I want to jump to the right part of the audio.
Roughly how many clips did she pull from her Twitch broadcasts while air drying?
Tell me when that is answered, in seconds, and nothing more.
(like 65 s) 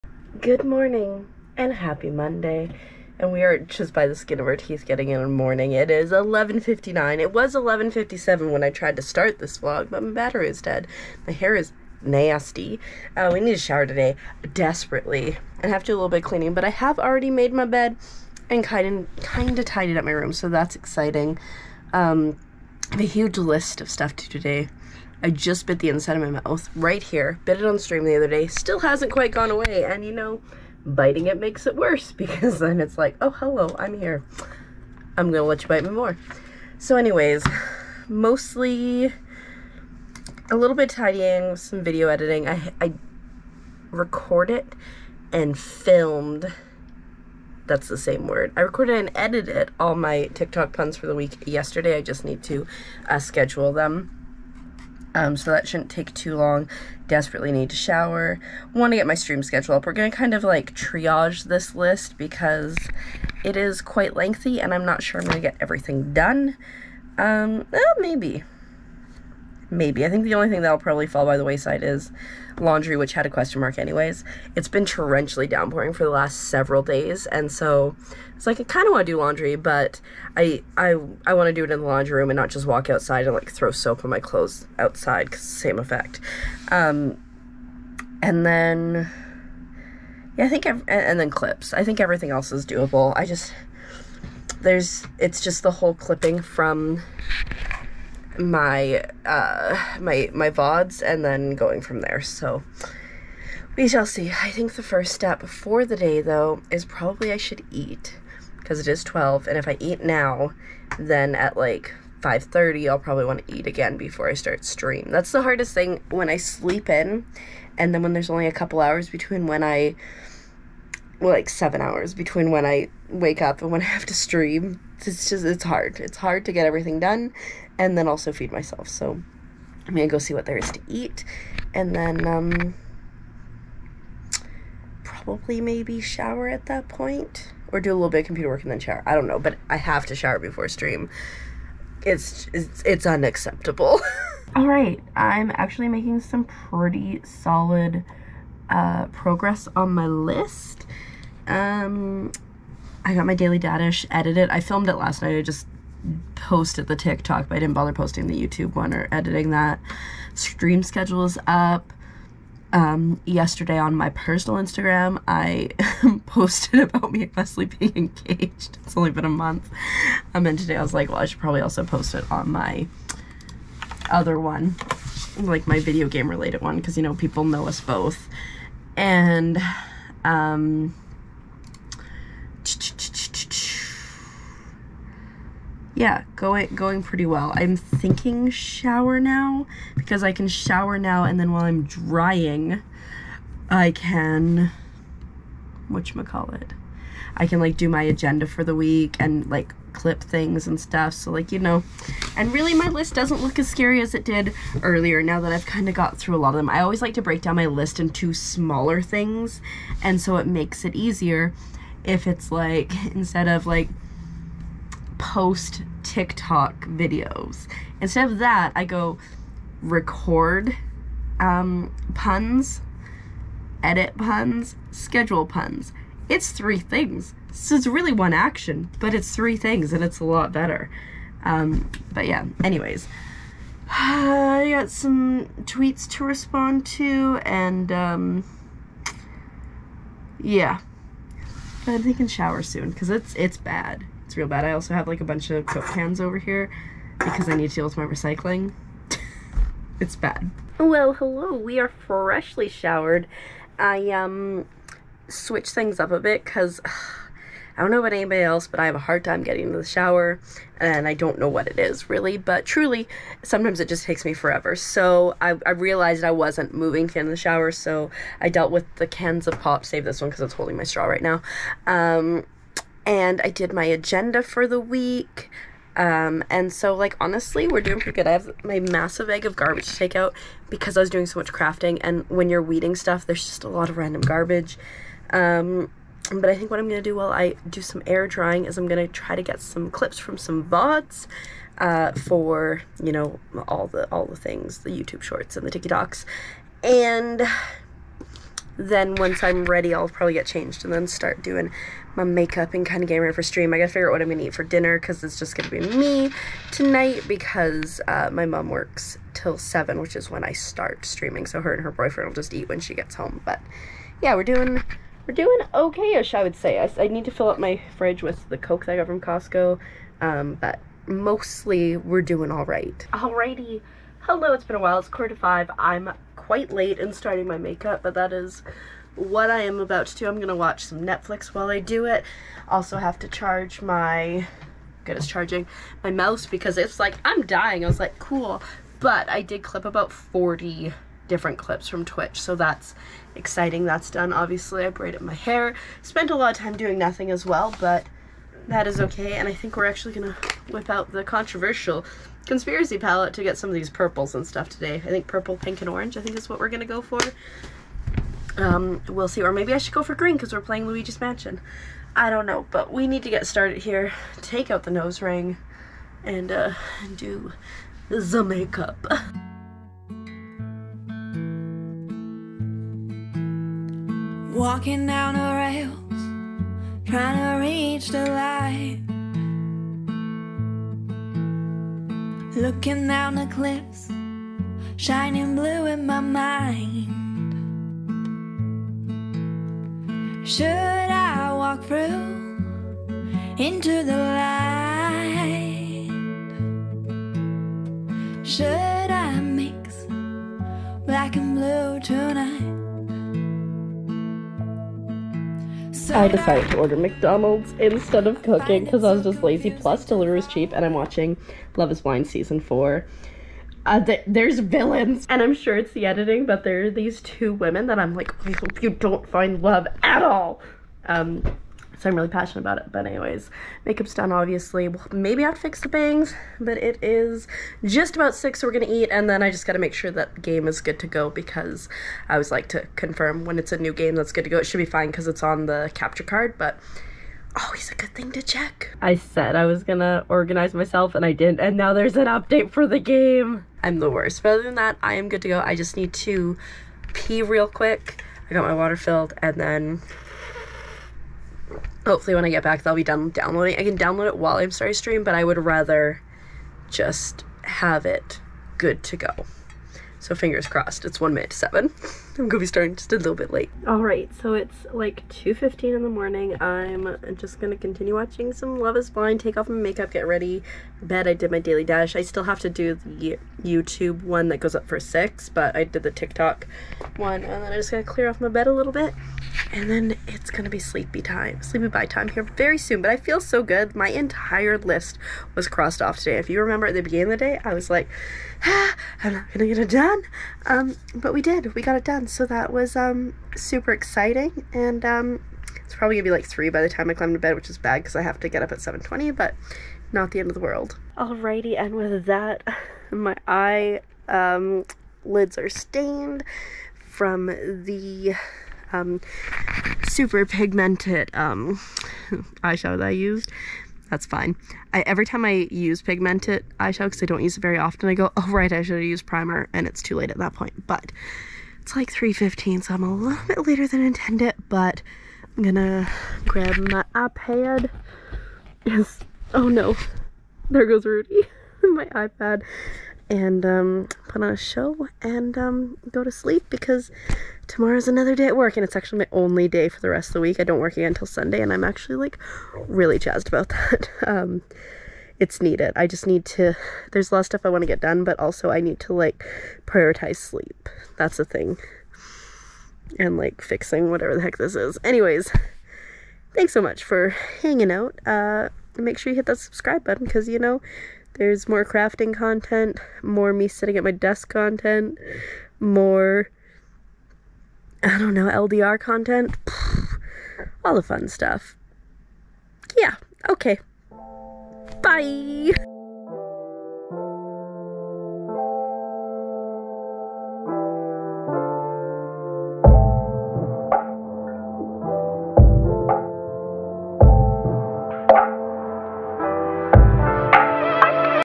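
340 s.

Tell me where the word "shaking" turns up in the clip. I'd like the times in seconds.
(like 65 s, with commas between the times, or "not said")
not said.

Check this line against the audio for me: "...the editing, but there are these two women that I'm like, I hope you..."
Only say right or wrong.
right.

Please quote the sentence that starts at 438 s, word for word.
I said I was gonna organize myself and I didn't, and now there's an update for the game.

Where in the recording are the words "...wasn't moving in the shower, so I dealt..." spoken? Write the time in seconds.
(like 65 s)
266 s.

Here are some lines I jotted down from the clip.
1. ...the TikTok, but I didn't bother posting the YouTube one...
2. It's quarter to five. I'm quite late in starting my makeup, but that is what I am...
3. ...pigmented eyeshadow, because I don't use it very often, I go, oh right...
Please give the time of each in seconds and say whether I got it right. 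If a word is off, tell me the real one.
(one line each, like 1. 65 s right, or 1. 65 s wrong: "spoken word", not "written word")
1. 156 s right
2. 324 s right
3. 516 s right.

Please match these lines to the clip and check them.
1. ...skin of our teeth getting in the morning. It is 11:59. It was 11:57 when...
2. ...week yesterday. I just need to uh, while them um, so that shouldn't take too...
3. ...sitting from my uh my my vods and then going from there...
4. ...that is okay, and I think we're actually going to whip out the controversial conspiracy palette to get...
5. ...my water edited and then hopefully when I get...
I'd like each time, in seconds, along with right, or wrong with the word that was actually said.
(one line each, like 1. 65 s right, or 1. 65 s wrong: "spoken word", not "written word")
1. 4 s right
2. 51 s wrong: "schedule", not "while"
3. 95 s wrong: "clipping", not "sitting"
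4. 348 s right
5. 448 s wrong: "filled", not "edited".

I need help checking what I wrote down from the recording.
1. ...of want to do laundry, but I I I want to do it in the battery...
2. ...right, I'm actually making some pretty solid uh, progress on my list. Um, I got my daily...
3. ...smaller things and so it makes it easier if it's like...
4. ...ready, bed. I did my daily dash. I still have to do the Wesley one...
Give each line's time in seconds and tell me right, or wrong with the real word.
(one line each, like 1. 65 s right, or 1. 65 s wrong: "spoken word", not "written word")
1. 78 s wrong: "laundry", not "battery"
2. 144 s right
3. 208 s right
4. 470 s wrong: "YouTube", not "Wesley".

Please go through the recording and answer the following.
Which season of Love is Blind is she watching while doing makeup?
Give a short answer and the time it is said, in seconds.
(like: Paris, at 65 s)
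Season 4, at 412 s.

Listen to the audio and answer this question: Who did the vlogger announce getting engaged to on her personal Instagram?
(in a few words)
Wesley.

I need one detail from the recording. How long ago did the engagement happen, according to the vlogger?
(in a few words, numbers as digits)
A month.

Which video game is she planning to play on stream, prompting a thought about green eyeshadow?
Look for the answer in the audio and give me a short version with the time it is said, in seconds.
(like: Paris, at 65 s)
Luigi's Mansion, at 360 s.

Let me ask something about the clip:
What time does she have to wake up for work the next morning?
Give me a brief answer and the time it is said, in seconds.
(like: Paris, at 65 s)
7:20, at 498 s.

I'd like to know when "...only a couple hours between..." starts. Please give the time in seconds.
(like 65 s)
118 s.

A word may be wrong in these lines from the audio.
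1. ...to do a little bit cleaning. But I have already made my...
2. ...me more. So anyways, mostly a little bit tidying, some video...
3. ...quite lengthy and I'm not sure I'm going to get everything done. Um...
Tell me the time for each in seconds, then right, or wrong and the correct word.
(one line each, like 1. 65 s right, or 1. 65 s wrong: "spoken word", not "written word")
1. 15 s right
2. 35 s right
3. 63 s right.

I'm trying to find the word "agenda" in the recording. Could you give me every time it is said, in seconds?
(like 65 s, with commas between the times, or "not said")
198 s, 273 s.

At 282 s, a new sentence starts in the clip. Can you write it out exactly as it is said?
And when you're weeding stuff, there's just a lot of random garbage.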